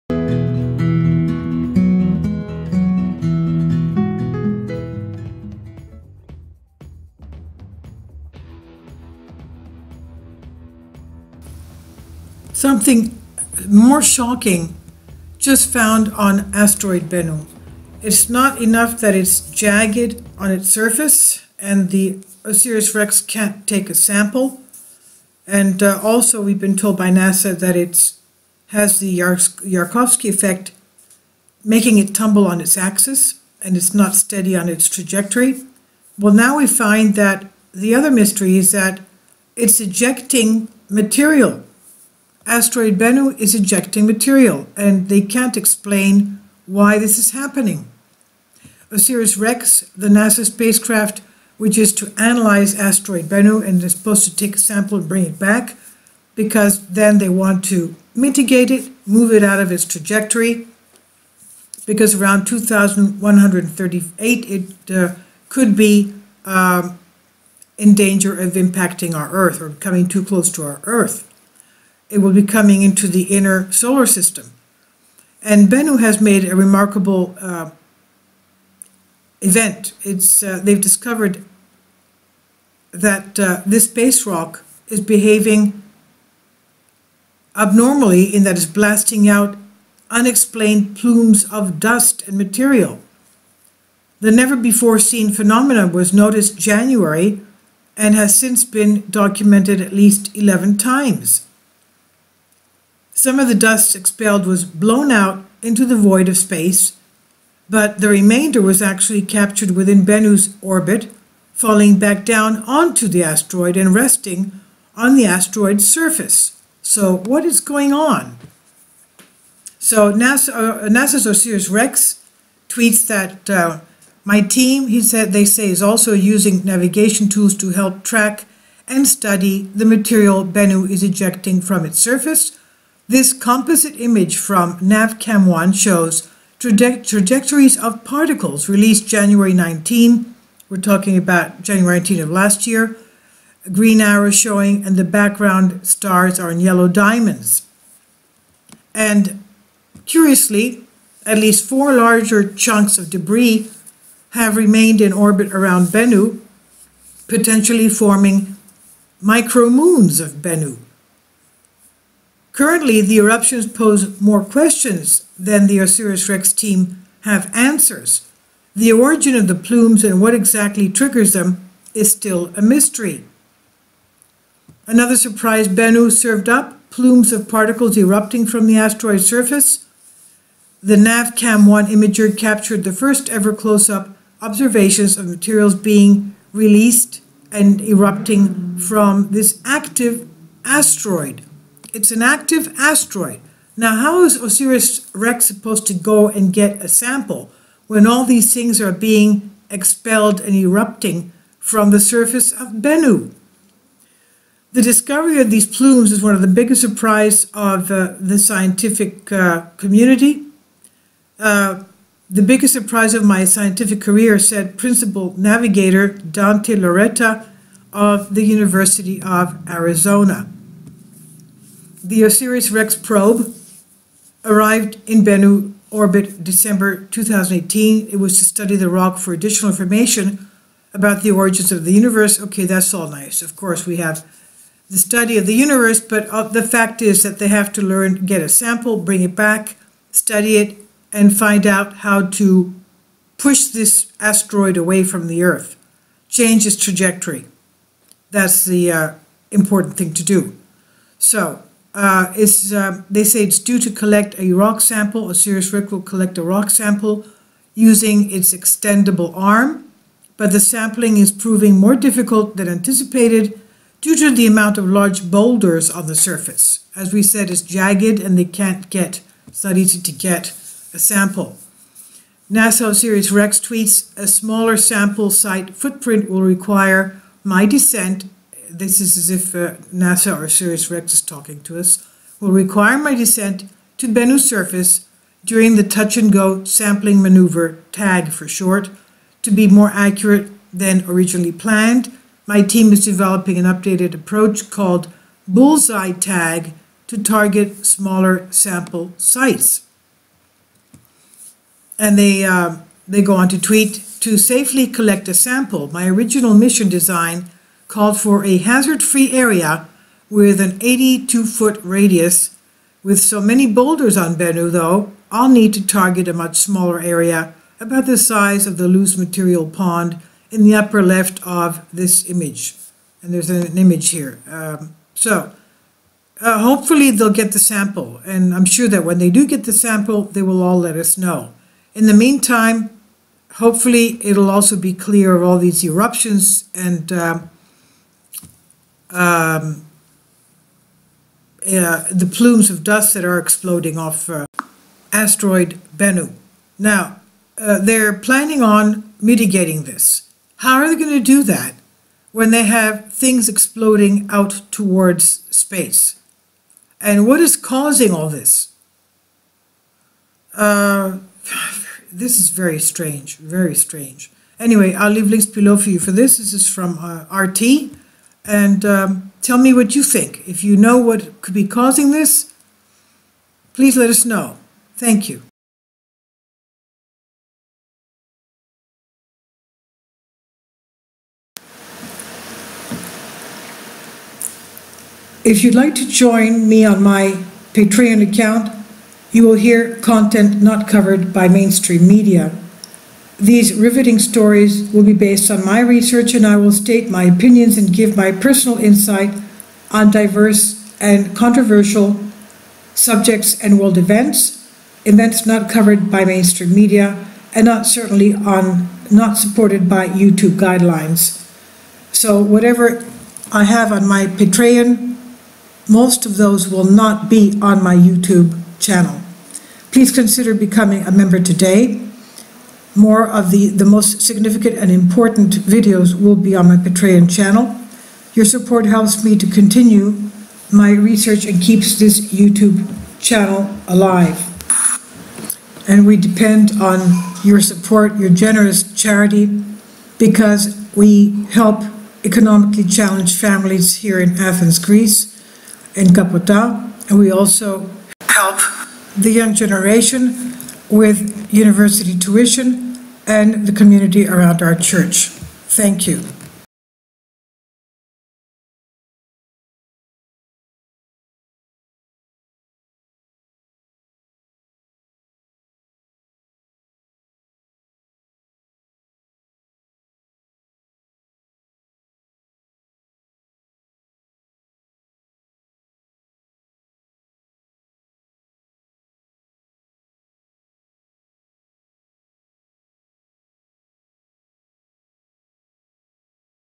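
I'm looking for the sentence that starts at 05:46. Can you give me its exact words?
Now, uh, they're planning on mitigating this.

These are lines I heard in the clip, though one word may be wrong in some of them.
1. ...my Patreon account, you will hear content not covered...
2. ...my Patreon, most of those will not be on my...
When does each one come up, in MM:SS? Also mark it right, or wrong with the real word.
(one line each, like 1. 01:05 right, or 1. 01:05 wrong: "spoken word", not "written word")
1. 06:27 right
2. 06:54 right.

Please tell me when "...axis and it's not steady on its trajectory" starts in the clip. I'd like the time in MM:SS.
00:32.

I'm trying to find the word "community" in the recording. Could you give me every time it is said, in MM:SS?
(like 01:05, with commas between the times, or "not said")
03:29, 07:33.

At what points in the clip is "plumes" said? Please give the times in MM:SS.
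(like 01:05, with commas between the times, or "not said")
01:30, 02:49, 02:56, 03:25, 05:42.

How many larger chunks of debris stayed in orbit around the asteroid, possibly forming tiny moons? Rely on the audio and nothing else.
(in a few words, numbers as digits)
4.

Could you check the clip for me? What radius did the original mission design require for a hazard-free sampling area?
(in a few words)
82 feet.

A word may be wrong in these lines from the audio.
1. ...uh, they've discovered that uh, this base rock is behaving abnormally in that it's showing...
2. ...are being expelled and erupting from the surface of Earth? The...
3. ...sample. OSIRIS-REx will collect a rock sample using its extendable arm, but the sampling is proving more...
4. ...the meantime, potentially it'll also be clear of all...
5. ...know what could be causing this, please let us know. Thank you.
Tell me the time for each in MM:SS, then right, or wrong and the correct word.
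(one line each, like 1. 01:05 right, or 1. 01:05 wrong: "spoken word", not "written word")
1. 01:20 wrong: "blasting", not "showing"
2. 03:18 wrong: "Bennu", not "Earth"
3. 04:14 right
4. 05:32 wrong: "hopefully", not "potentially"
5. 06:10 right.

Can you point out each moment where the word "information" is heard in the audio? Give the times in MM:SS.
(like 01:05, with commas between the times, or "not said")
03:49.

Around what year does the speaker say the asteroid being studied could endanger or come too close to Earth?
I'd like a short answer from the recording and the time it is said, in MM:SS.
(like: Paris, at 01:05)
2138, at 01:02.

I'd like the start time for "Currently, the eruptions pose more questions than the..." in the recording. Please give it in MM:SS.
02:42.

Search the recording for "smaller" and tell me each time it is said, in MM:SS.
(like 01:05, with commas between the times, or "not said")
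04:34, 04:57, 05:16.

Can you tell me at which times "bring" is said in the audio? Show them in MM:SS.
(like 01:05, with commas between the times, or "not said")
00:55, 03:58.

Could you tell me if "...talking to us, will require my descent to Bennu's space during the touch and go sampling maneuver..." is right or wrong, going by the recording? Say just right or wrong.
wrong.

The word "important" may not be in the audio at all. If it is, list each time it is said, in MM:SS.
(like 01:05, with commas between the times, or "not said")
04:09, 07:04.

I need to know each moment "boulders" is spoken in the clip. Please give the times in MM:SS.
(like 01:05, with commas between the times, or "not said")
04:25, 05:13.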